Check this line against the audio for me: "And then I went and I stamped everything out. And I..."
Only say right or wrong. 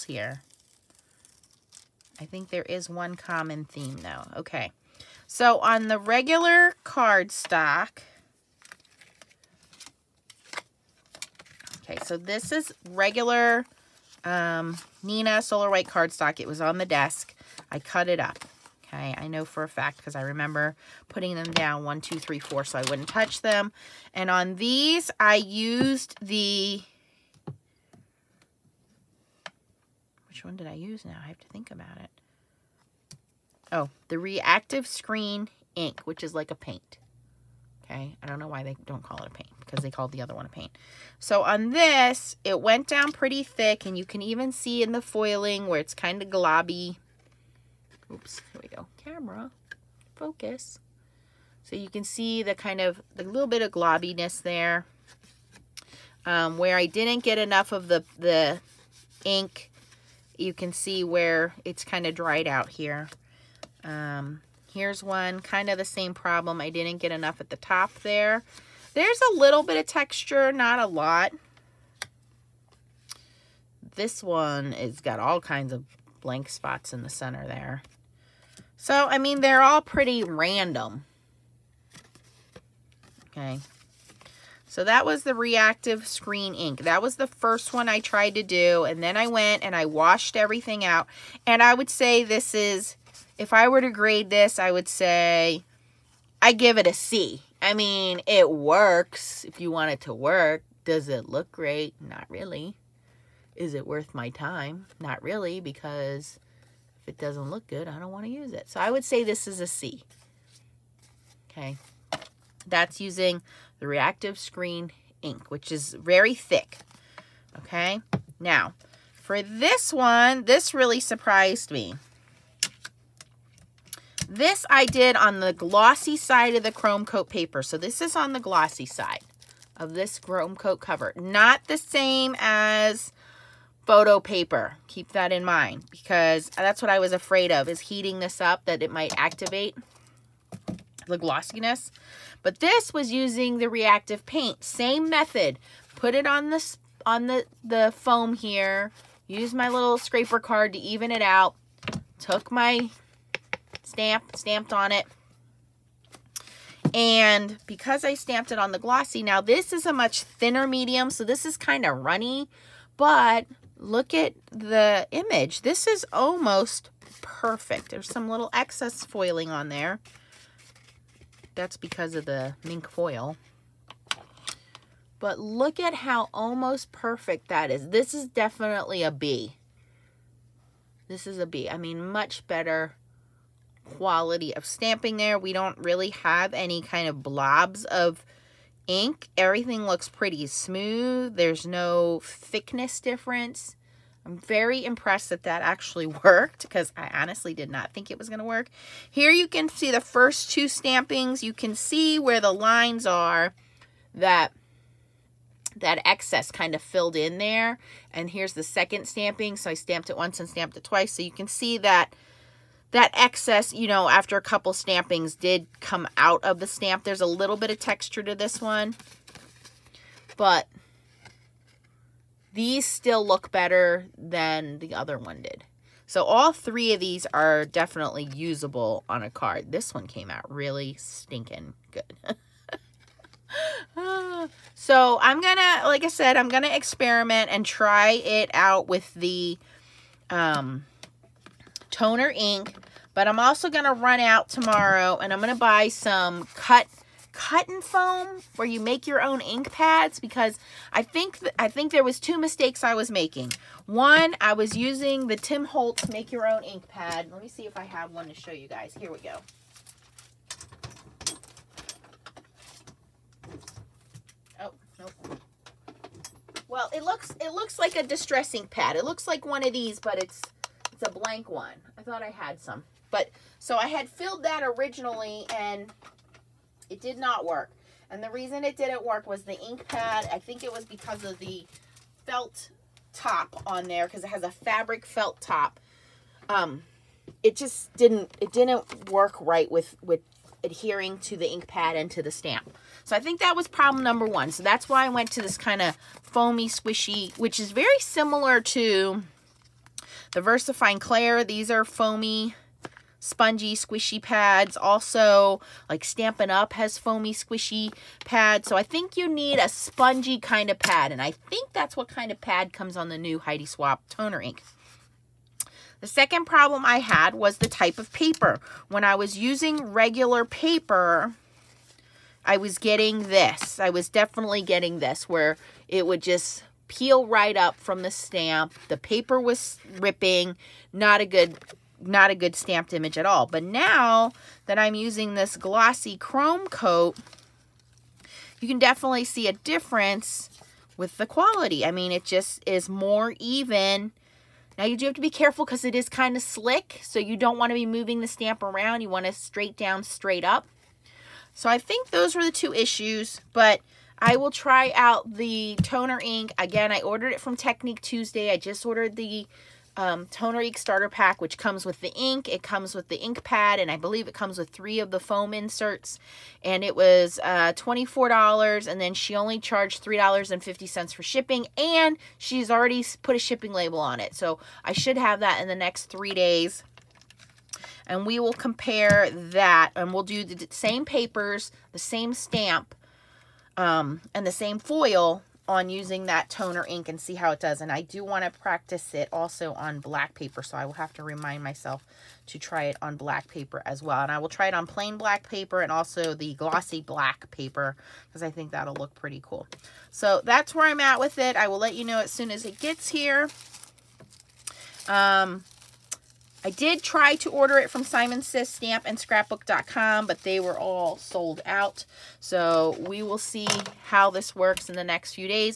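wrong.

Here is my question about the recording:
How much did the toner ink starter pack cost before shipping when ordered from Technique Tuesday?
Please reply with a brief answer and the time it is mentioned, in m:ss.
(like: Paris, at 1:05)
$24, at 6:07.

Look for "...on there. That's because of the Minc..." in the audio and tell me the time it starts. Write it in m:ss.
2:49.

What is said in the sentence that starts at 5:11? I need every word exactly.
And I think that's what kind of pad comes on the new Heidi Swapp toner ink.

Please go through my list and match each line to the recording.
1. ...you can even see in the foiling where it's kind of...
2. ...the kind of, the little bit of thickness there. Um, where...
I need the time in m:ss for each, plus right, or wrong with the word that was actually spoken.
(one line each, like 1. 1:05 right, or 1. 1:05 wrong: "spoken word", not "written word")
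1. 0:43 right
2. 0:52 wrong: "globbiness", not "thickness".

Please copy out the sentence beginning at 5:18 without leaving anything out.
When I was using regular paper, I was getting this.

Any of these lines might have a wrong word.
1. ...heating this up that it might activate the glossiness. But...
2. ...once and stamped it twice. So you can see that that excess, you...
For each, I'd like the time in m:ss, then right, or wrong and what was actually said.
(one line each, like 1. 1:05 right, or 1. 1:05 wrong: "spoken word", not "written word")
1. 2:17 right
2. 3:30 right.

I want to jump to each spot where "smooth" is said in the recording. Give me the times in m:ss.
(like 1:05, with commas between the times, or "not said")
3:10.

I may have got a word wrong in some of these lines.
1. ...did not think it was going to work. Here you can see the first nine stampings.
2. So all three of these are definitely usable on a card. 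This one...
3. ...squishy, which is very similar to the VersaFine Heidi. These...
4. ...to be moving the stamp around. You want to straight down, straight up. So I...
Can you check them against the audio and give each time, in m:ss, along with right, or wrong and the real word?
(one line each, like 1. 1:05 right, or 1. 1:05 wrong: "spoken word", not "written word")
1. 3:17 wrong: "two", not "nine"
2. 3:46 right
3. 4:56 wrong: "Clair", not "Heidi"
4. 5:47 right.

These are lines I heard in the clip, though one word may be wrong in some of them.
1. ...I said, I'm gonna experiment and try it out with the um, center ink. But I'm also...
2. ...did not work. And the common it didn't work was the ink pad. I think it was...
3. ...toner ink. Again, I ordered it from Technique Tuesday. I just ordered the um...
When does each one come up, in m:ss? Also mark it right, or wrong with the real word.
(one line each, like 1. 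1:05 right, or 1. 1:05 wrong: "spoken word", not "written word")
1. 3:56 wrong: "toner", not "center"
2. 4:37 wrong: "reason", not "common"
3. 5:55 right.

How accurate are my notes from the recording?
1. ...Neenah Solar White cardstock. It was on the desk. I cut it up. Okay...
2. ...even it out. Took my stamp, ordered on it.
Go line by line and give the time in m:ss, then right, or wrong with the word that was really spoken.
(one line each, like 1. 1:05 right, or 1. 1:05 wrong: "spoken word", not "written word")
1. 0:15 right
2. 2:30 wrong: "stamped", not "ordered".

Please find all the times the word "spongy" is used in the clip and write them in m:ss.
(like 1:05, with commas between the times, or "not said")
5:03, 5:09.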